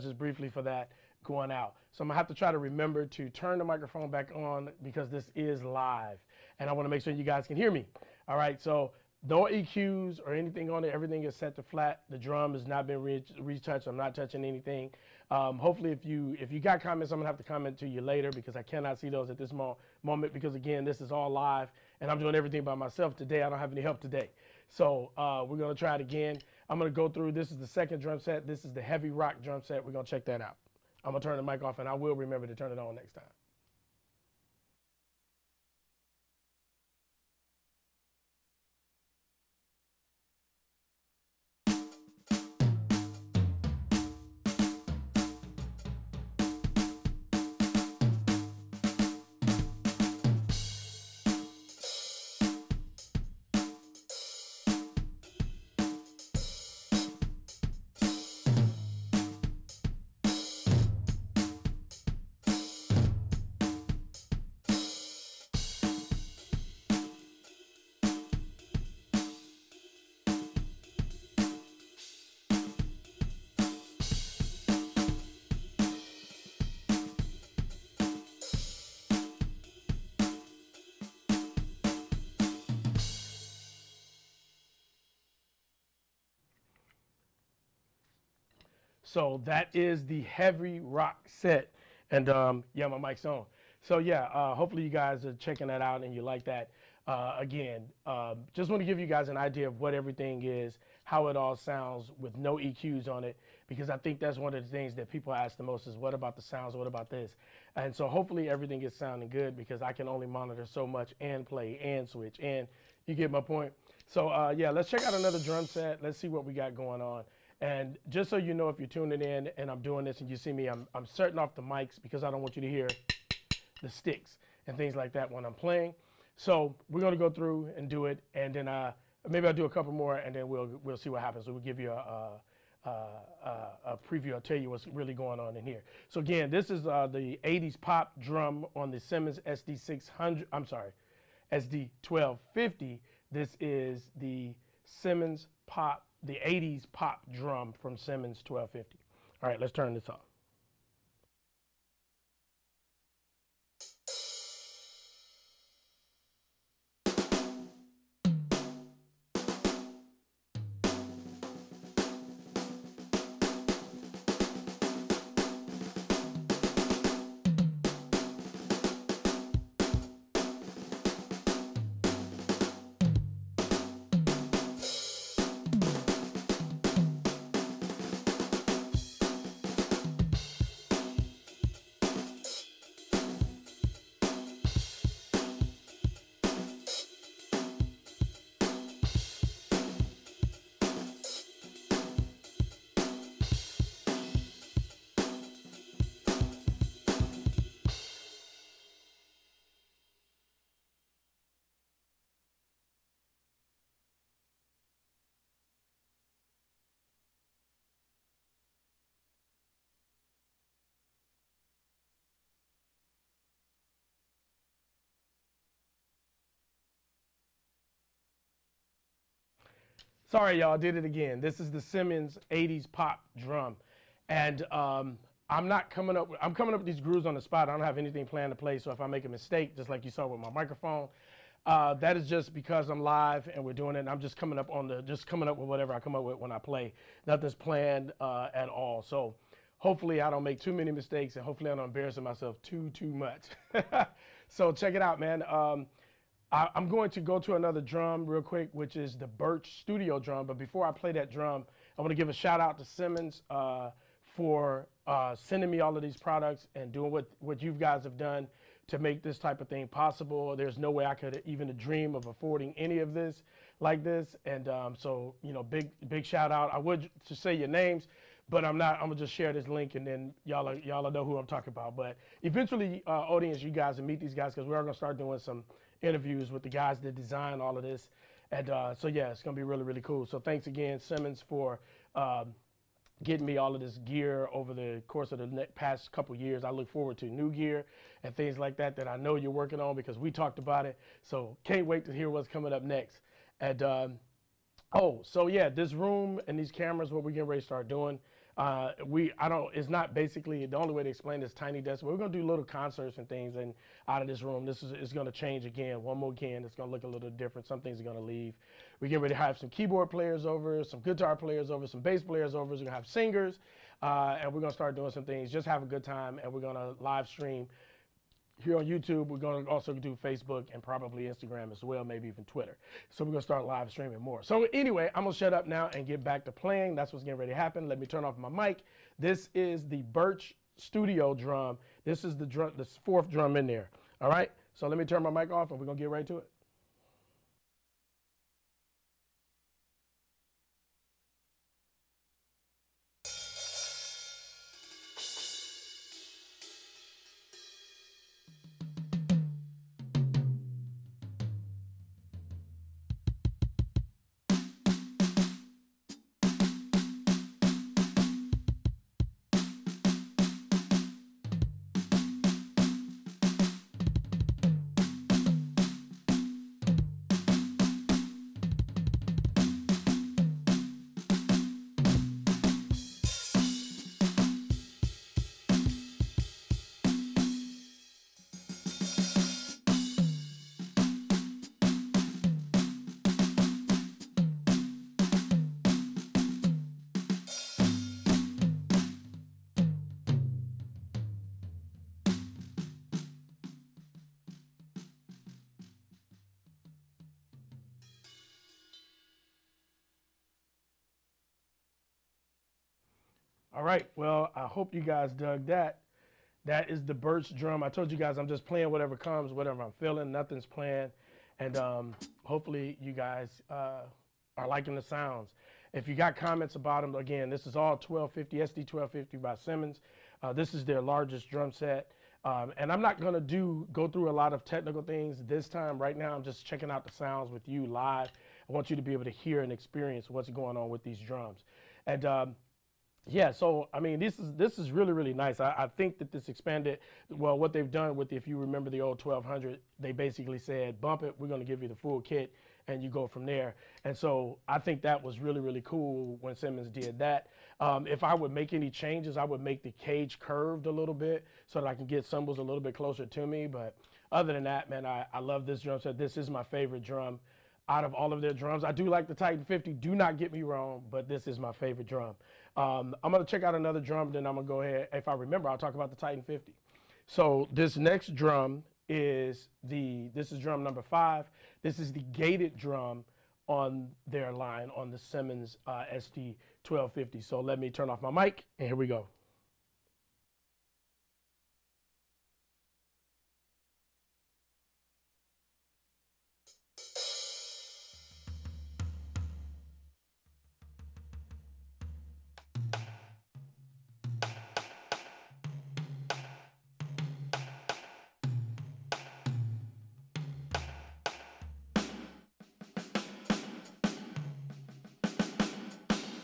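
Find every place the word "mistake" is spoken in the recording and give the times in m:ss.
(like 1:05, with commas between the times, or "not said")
3:49, 4:00.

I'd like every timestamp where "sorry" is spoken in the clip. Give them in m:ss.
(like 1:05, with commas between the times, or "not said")
2:20, 3:40.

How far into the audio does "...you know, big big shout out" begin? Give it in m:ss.
4:25.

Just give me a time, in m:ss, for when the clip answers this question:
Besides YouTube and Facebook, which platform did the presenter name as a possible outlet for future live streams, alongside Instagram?
5:22.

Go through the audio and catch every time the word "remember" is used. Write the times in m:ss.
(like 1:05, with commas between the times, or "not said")
0:02, 0:32, 7:18, 7:45.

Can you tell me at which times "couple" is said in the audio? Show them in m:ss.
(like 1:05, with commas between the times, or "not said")
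2:09, 4:46.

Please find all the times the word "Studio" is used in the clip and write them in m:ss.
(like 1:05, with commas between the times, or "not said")
4:09, 5:30.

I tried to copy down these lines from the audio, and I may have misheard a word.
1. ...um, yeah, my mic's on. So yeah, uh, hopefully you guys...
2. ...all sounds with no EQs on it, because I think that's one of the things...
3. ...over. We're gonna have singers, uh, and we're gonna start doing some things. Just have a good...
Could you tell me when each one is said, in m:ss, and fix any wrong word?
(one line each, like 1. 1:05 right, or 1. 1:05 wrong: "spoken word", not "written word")
1. 1:32 right
2. 1:41 right
3. 5:12 right.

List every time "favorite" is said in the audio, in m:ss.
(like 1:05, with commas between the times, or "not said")
7:36, 7:41.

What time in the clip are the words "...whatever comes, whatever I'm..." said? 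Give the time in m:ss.
6:48.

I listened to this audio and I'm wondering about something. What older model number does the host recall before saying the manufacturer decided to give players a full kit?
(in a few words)
1200.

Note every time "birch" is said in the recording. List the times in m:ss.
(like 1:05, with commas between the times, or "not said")
4:09, 5:30, 6:47.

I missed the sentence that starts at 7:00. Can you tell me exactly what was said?
Uh, this is their largest drum set.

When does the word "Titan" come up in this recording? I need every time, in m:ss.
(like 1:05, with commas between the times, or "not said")
7:39, 7:46.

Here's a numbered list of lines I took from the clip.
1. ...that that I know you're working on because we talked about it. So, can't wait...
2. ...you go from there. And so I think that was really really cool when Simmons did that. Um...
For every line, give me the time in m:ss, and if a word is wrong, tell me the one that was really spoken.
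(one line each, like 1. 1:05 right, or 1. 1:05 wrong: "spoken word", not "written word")
1. 4:48 right
2. 7:23 right.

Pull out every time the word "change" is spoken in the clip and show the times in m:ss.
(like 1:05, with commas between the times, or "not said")
5:05, 7:28.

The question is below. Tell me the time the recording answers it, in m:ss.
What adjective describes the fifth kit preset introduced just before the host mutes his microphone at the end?
7:52.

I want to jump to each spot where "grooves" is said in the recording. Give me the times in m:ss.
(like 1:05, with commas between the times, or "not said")
3:46.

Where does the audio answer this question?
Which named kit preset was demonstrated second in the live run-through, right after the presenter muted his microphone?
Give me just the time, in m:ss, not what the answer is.
0:28.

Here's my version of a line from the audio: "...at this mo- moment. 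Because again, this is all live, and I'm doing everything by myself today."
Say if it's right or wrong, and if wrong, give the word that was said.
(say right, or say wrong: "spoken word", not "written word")
right.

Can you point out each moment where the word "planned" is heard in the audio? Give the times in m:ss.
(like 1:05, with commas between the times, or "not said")
3:48, 3:57, 6:50.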